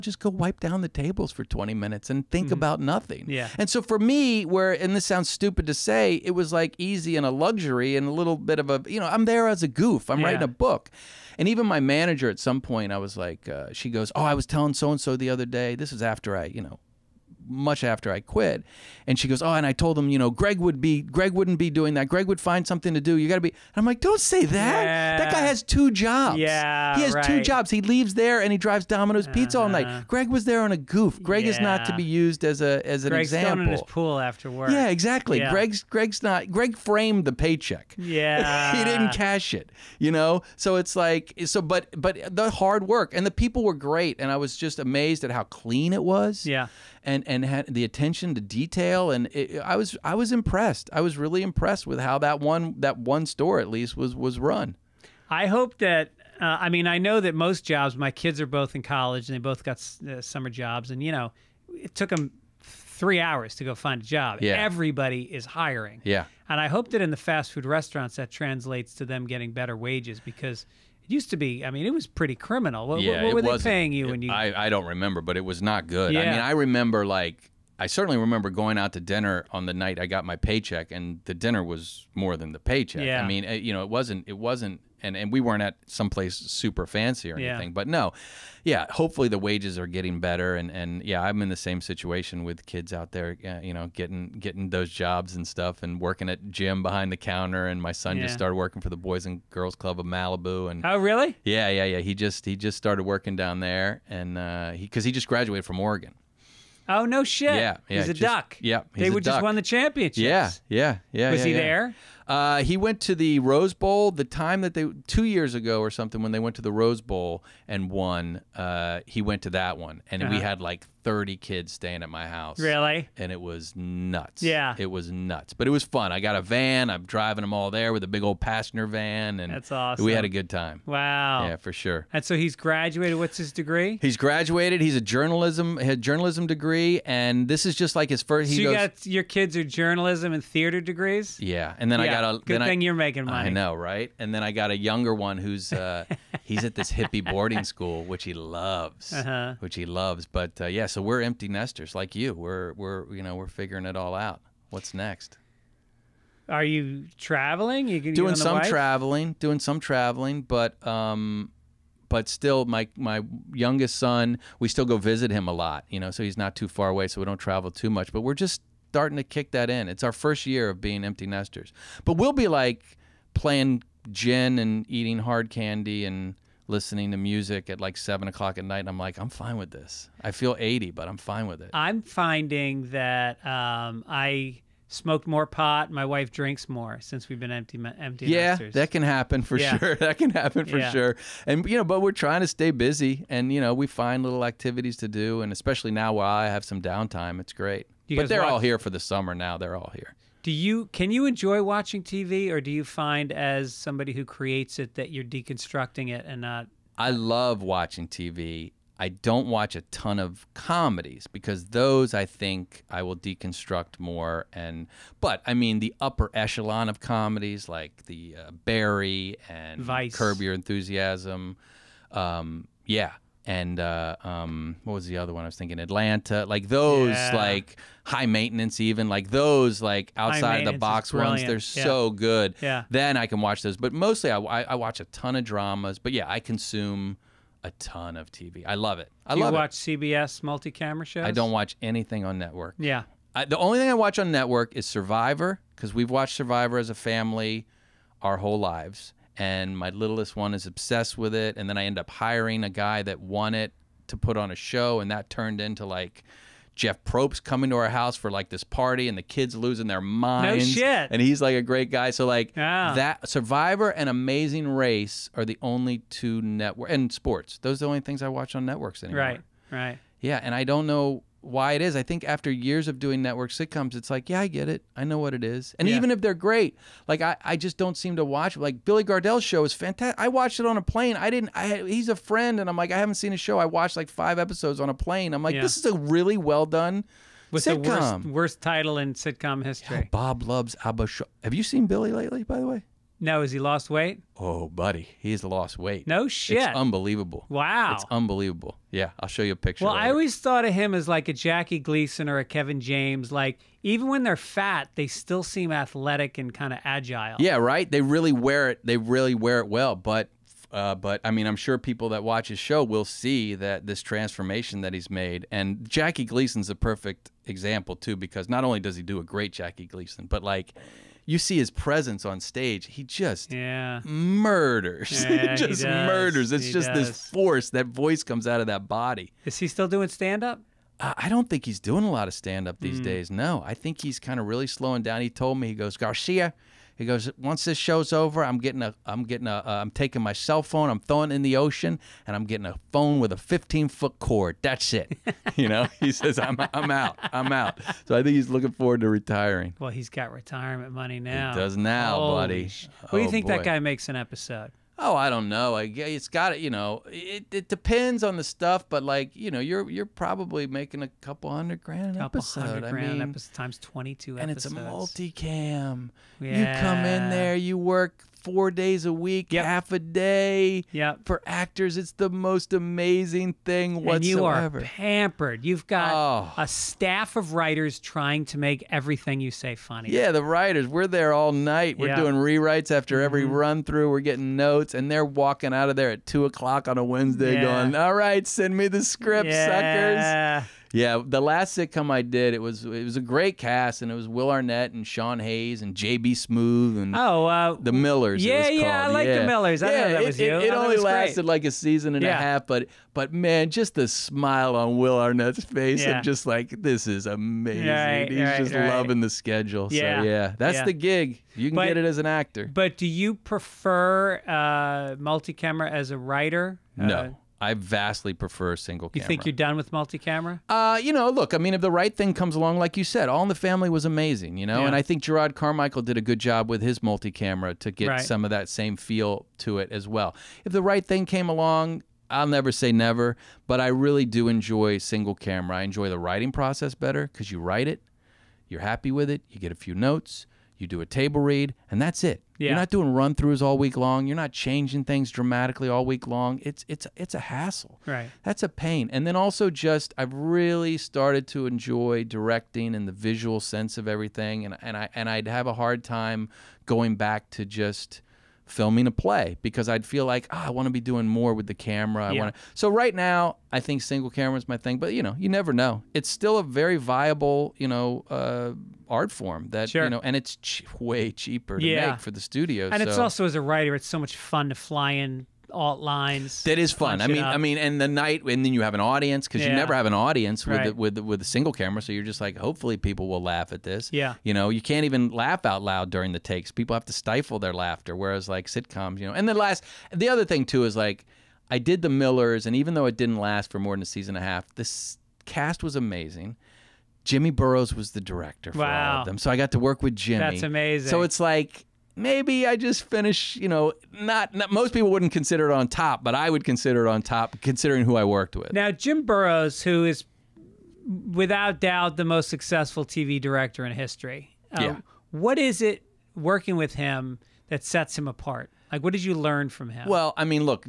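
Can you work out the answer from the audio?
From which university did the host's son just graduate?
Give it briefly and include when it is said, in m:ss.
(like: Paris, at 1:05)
Oregon, at 1:45.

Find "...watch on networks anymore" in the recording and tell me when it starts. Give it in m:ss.
4:28.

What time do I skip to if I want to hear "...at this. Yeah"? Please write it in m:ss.
8:03.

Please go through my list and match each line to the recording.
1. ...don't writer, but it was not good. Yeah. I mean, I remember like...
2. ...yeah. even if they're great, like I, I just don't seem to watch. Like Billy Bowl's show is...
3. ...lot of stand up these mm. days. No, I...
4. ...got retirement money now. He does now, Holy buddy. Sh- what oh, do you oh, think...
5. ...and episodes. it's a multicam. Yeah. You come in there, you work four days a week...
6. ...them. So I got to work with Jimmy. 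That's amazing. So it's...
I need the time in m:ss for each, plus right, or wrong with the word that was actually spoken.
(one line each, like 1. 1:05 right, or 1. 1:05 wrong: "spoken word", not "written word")
1. 1:14 wrong: "remember", not "writer"
2. 4:35 wrong: "Gardell", not "Bowl"
3. 5:32 right
4. 5:50 right
5. 6:04 right
6. 8:19 right.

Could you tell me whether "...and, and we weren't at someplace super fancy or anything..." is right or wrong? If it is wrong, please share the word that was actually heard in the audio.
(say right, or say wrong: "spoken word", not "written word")
right.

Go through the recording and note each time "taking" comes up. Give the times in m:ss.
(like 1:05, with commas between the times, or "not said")
5:39.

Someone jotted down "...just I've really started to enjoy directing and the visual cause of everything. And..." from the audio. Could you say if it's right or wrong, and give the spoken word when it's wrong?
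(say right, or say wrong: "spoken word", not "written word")
wrong: "sense", not "cause".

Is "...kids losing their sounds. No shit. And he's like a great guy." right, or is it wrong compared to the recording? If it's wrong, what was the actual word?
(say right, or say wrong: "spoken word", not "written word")
wrong: "minds", not "sounds".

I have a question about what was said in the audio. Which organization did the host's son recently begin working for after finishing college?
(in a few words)
Boys and Girls Club of Malibu.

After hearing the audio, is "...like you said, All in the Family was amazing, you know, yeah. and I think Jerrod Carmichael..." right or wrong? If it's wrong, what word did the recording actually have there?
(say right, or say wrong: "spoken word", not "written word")
right.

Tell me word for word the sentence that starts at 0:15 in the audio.
This is after I, you know, much after I quit.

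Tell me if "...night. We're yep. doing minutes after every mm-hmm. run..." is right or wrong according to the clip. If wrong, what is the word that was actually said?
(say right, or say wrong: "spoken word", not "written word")
wrong: "rewrites", not "minutes".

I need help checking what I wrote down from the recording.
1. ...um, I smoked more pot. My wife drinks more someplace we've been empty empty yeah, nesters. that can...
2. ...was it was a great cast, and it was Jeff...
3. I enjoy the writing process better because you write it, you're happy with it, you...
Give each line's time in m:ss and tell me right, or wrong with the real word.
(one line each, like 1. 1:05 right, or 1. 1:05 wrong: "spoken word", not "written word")
1. 3:03 wrong: "since", not "someplace"
2. 6:32 wrong: "Will", not "Jeff"
3. 7:15 right.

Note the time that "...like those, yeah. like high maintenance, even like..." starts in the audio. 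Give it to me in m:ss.
3:46.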